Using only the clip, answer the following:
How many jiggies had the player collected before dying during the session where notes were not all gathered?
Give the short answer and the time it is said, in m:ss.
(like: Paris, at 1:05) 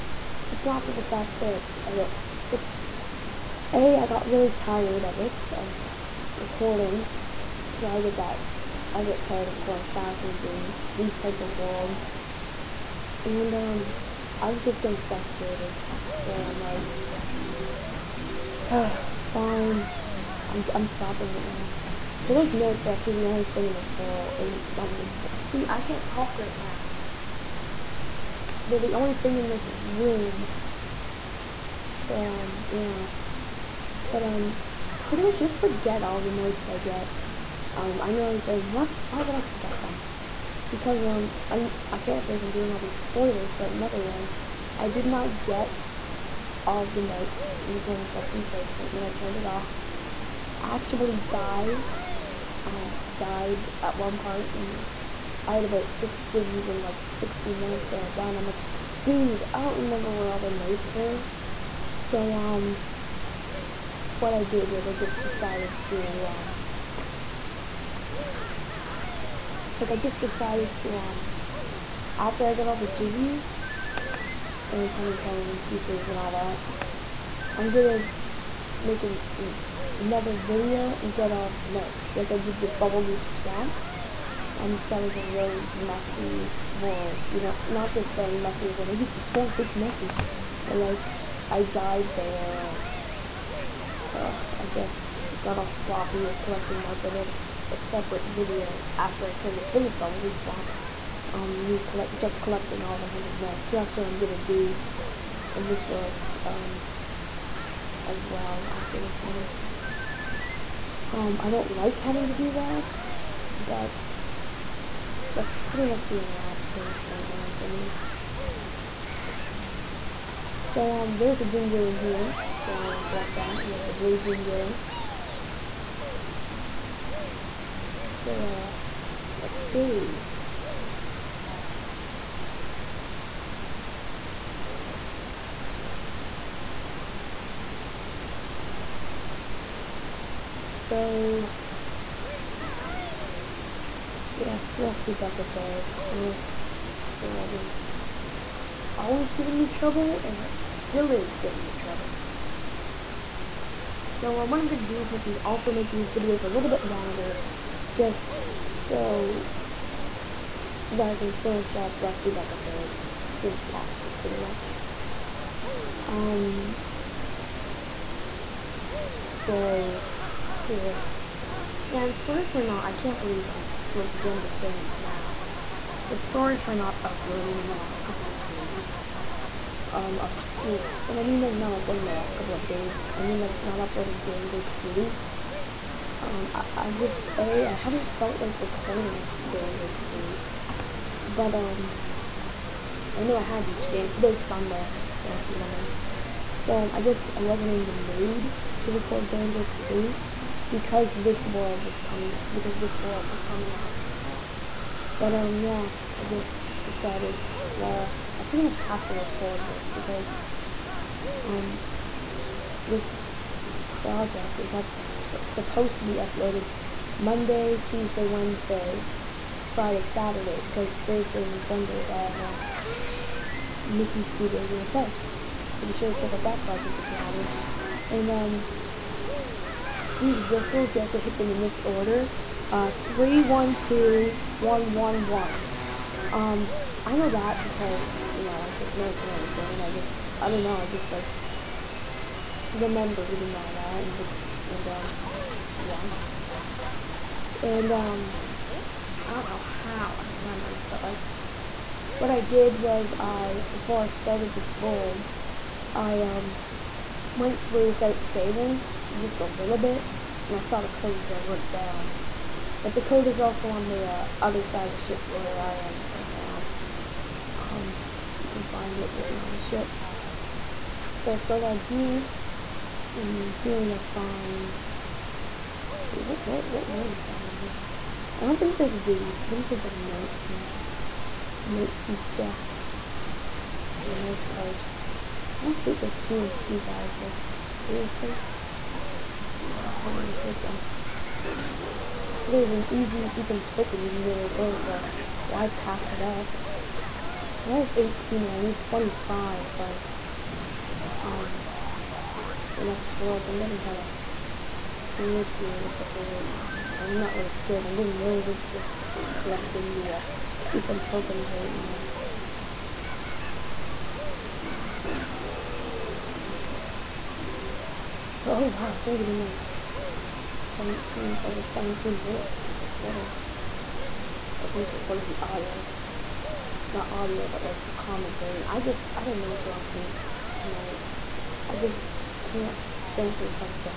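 6, at 0:55.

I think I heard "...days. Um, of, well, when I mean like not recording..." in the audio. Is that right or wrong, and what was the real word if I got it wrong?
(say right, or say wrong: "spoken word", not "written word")
wrong: "uploading", not "recording".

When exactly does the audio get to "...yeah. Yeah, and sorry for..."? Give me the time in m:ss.
2:50.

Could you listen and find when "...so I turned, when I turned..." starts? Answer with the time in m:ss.
0:48.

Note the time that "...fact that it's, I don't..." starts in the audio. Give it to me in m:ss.
0:01.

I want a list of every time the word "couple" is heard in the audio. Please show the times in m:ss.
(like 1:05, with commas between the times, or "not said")
2:58, 3:02.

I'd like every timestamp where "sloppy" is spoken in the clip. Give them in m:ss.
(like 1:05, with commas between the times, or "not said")
1:35.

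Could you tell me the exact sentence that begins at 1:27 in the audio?
You know, not just saying messy as like it's a swamp, it's messy, but like I died there.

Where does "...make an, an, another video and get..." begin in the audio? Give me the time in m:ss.
1:18.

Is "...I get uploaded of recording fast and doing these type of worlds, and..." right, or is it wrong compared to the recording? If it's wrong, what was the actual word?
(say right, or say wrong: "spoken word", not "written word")
wrong: "tired", not "uploaded".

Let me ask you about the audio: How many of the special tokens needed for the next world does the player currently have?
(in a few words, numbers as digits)
18.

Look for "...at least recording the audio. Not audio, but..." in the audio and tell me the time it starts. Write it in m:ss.
5:24.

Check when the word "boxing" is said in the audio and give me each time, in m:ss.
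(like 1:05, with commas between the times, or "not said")
not said.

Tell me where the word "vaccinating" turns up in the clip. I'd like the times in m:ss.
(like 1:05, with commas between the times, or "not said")
not said.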